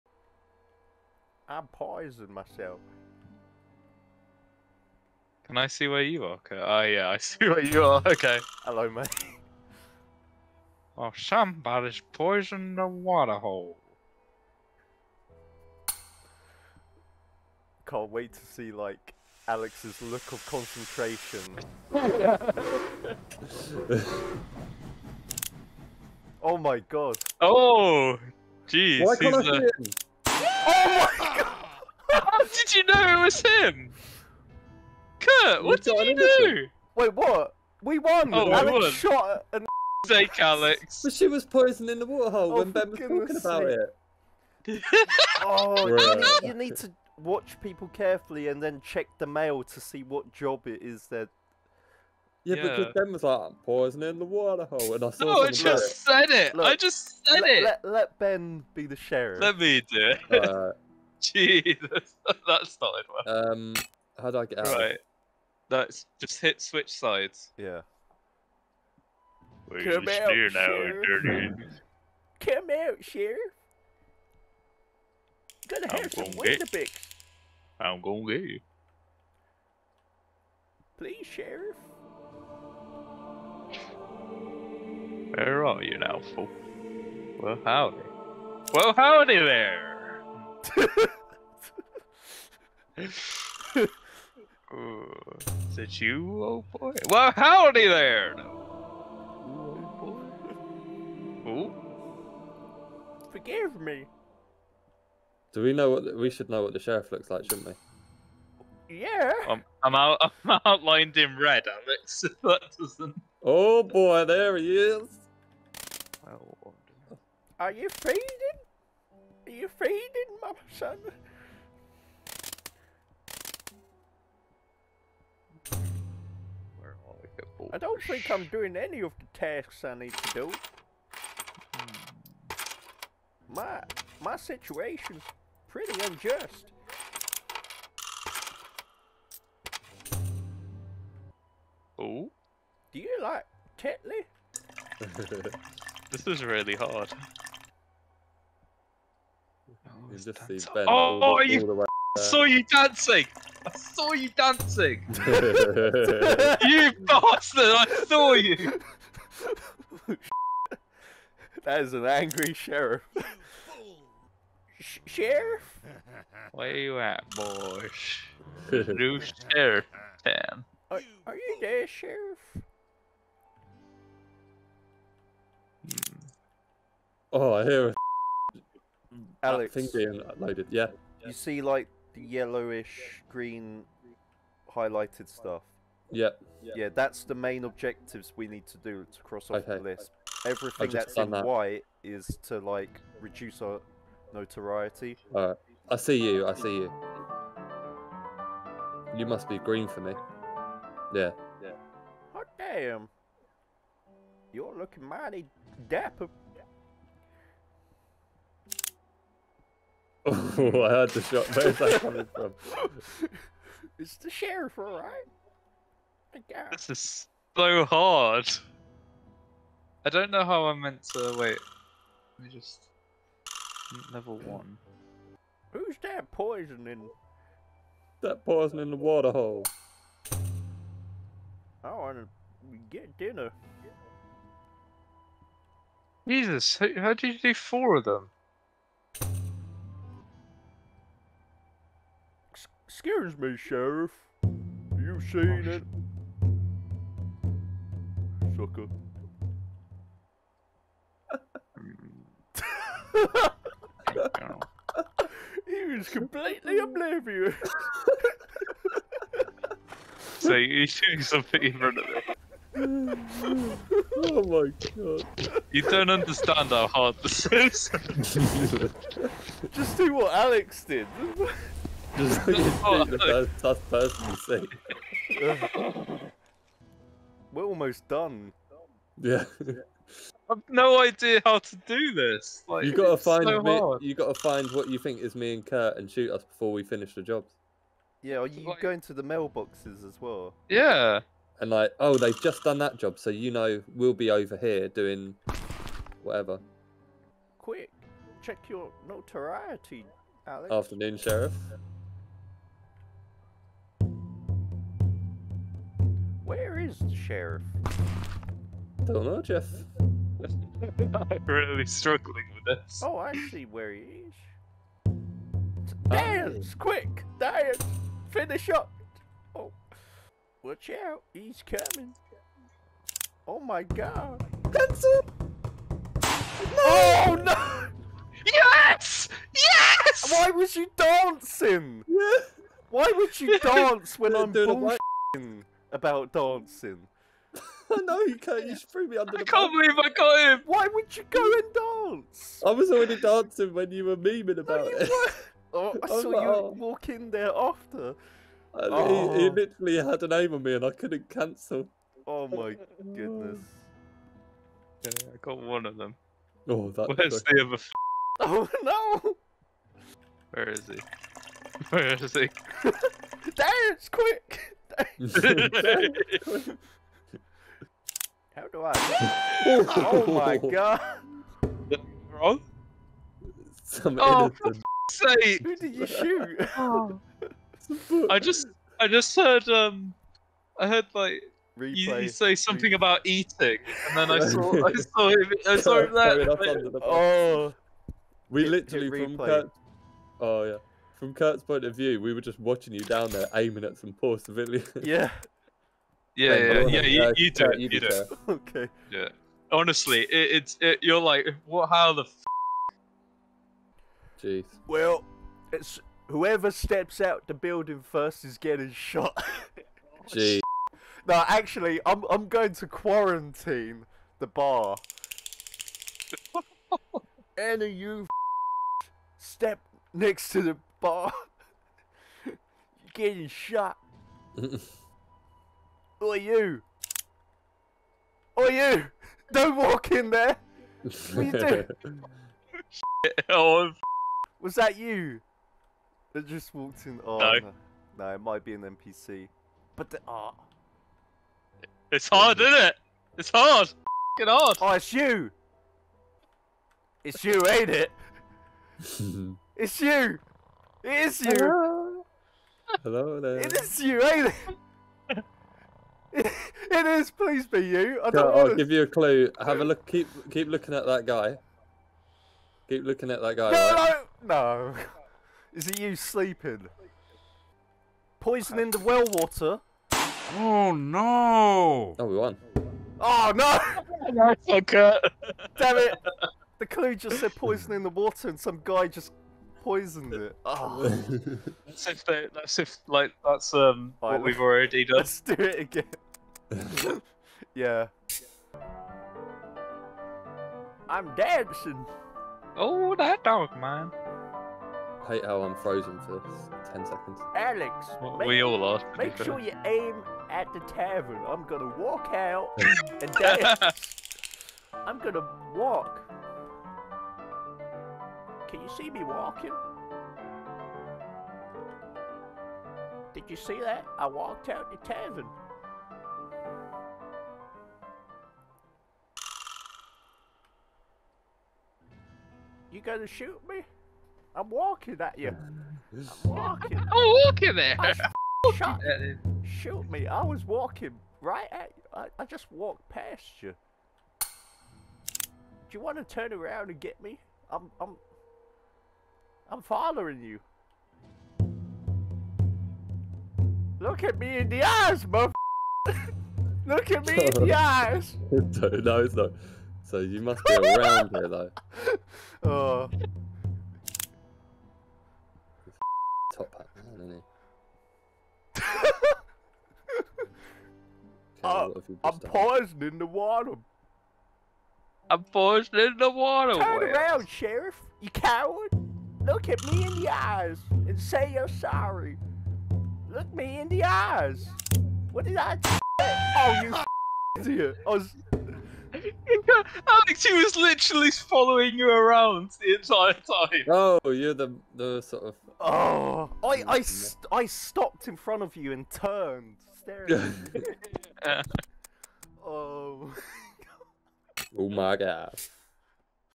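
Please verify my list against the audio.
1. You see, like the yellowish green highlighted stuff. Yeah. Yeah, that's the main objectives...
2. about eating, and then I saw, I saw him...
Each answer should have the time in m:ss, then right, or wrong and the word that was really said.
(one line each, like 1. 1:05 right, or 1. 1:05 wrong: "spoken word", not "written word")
1. 3:01 right
2. 6:22 right.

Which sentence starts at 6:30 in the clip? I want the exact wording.
Oh yeah from Kurt's point of view, we were just watching you down there aiming at some poor civilians.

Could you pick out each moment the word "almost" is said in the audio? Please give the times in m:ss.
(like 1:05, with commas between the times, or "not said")
4:37.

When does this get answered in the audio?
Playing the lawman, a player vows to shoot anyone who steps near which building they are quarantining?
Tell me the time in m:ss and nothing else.
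6:54.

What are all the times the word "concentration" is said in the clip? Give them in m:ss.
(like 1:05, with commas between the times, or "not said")
0:20.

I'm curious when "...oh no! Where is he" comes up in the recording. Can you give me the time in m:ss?
5:58.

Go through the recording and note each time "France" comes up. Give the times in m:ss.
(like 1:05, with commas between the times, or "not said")
not said.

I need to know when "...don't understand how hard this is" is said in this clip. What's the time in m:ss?
4:25.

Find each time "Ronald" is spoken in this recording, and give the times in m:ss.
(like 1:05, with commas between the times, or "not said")
not said.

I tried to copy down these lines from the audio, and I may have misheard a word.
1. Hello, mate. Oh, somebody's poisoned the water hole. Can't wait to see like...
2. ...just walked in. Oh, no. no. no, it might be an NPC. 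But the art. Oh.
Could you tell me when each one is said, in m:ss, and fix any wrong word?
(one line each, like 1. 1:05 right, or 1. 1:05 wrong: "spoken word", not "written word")
1. 0:08 right
2. 7:16 right.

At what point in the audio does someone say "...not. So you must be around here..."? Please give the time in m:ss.
9:09.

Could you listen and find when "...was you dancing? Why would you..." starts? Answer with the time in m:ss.
5:30.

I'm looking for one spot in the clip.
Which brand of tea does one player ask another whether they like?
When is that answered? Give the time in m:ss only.
2:23.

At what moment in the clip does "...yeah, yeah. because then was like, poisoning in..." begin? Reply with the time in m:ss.
0:52.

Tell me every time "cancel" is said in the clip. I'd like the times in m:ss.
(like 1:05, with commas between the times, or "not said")
5:51.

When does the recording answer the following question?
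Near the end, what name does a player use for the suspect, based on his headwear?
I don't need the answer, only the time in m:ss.
9:16.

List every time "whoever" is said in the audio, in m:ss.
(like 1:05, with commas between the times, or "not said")
6:46.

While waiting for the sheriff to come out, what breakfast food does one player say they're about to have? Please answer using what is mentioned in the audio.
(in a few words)
Weetabix.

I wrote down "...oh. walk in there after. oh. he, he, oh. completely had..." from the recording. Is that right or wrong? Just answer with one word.
wrong.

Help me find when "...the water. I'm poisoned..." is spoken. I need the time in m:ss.
9:23.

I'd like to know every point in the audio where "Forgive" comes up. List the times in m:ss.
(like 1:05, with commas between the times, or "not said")
1:43.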